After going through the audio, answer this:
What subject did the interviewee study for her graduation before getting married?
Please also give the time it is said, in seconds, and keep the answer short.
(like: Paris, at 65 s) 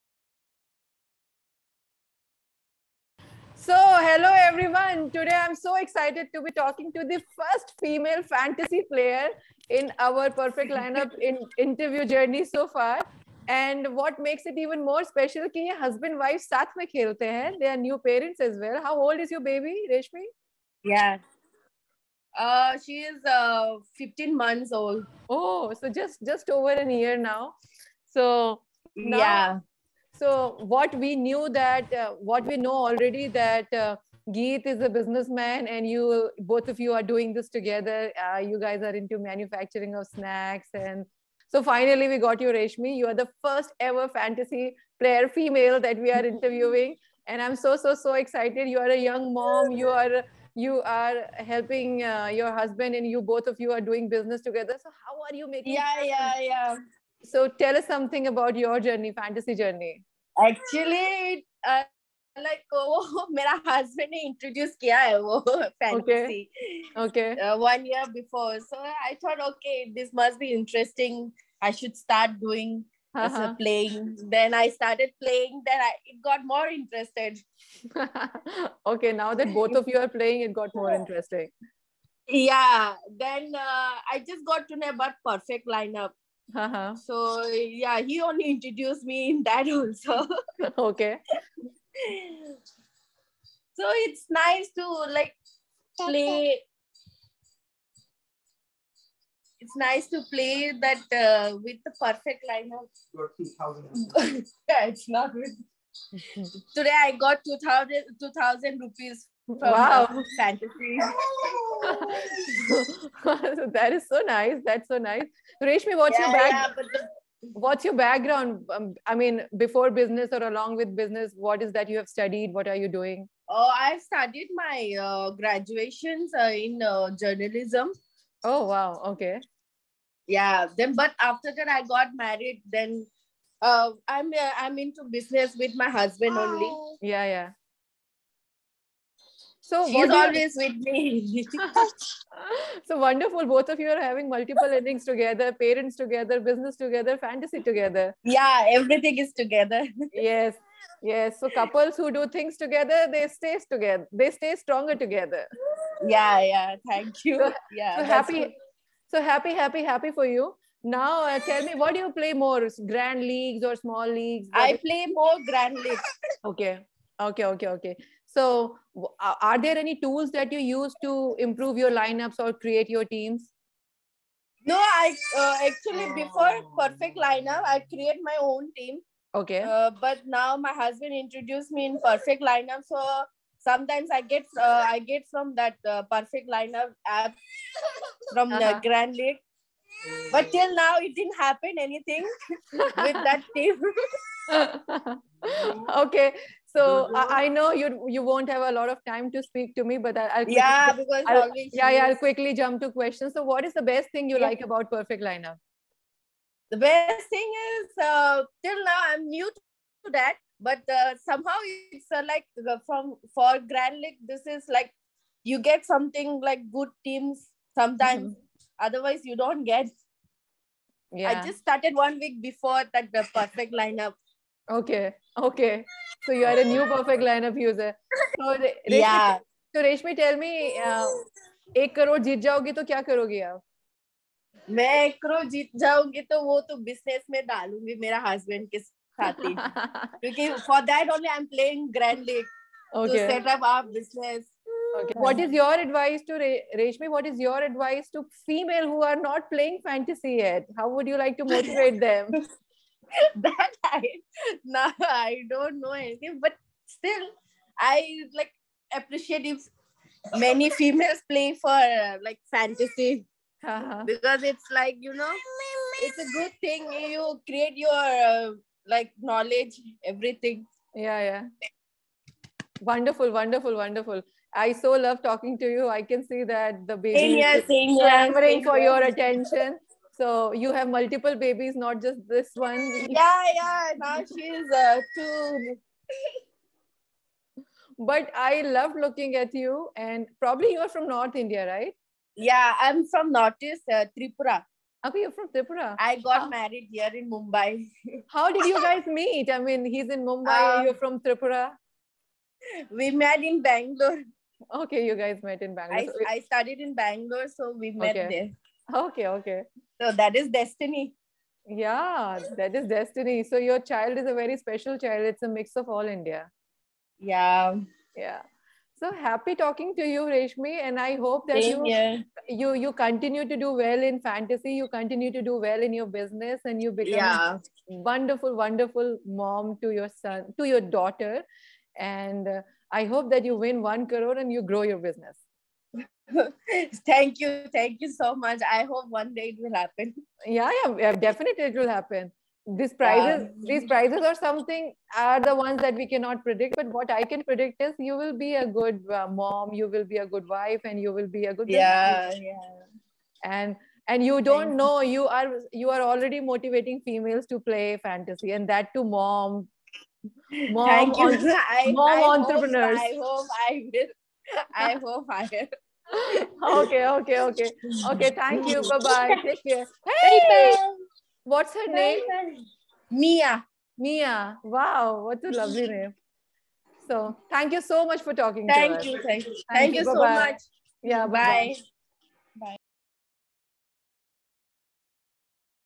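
Journalism, at 127 s.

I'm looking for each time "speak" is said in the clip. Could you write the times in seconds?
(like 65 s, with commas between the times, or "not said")
199 s.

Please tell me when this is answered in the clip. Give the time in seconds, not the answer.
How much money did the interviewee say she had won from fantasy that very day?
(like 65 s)
108 s.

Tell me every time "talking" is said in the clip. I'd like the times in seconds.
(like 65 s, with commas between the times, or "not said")
6 s, 275 s, 319 s, 378 s.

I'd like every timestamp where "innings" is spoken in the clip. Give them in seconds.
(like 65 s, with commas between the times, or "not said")
144 s.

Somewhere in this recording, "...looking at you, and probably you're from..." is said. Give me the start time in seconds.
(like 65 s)
288 s.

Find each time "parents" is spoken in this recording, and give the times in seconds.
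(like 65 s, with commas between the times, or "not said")
18 s, 145 s.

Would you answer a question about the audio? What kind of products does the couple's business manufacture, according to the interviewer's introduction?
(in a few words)
Snacks.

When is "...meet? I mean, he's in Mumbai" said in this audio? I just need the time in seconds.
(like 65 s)
299 s.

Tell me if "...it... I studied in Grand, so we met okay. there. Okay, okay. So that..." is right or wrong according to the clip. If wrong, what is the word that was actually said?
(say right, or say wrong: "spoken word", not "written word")
wrong: "Bangalore", not "Grand".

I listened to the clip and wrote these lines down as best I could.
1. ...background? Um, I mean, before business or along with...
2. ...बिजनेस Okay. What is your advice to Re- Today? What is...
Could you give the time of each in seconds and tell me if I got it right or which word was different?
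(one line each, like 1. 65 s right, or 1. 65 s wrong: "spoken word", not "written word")
1. 117 s right
2. 243 s wrong: "Reshmi", not "Today".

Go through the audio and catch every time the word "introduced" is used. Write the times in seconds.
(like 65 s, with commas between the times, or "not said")
88 s, 181 s.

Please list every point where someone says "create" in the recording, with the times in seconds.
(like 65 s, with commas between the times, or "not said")
172 s, 177 s, 267 s.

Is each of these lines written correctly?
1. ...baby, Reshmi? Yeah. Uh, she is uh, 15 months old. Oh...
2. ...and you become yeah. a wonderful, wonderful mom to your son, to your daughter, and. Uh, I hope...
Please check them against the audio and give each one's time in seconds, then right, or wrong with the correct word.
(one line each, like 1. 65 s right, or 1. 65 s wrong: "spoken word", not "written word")
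1. 19 s right
2. 326 s right.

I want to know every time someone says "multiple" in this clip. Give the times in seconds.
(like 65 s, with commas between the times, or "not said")
144 s, 280 s.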